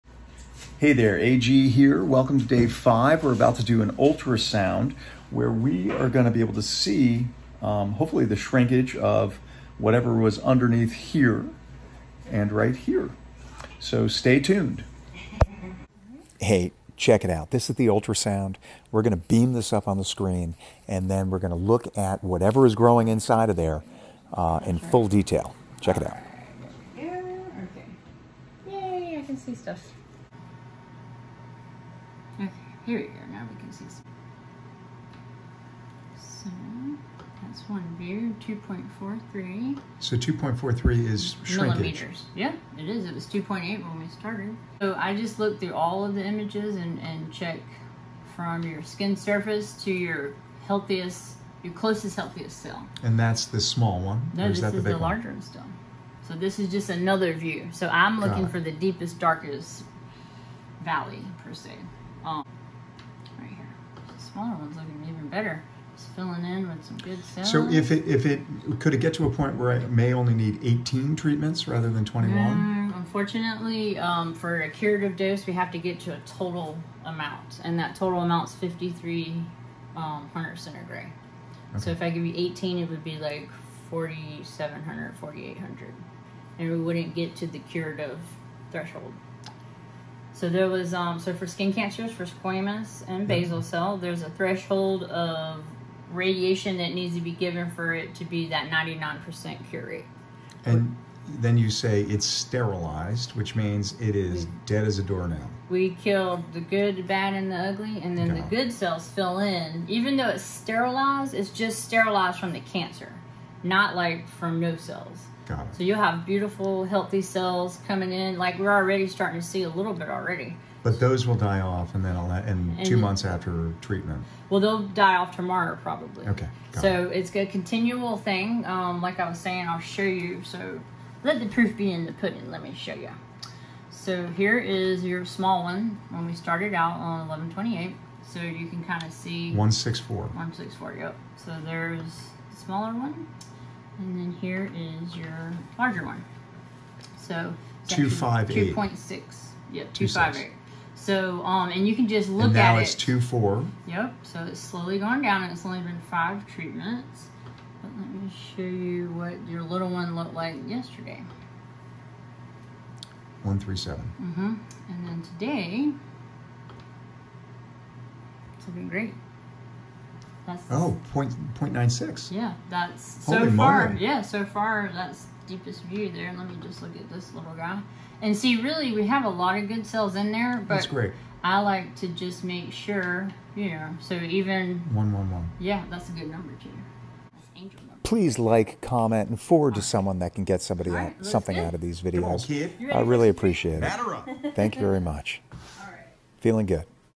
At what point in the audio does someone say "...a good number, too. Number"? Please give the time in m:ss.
3:06.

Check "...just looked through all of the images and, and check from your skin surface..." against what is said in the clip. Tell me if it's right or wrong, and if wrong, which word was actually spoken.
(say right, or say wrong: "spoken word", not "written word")
right.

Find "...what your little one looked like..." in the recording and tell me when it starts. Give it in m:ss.
2:39.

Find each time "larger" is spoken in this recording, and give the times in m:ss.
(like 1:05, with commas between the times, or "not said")
0:54, 2:25.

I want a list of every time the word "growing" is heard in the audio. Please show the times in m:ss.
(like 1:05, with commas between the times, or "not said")
0:22.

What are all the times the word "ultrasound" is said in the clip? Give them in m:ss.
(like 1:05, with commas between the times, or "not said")
0:03, 0:17.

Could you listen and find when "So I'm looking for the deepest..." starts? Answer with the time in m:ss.
0:57.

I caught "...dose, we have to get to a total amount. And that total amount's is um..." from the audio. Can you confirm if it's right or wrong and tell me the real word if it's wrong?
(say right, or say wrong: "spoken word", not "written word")
right.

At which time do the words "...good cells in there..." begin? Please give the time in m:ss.
2:59.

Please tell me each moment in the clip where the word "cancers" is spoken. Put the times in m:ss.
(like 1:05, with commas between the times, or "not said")
1:31, 1:52.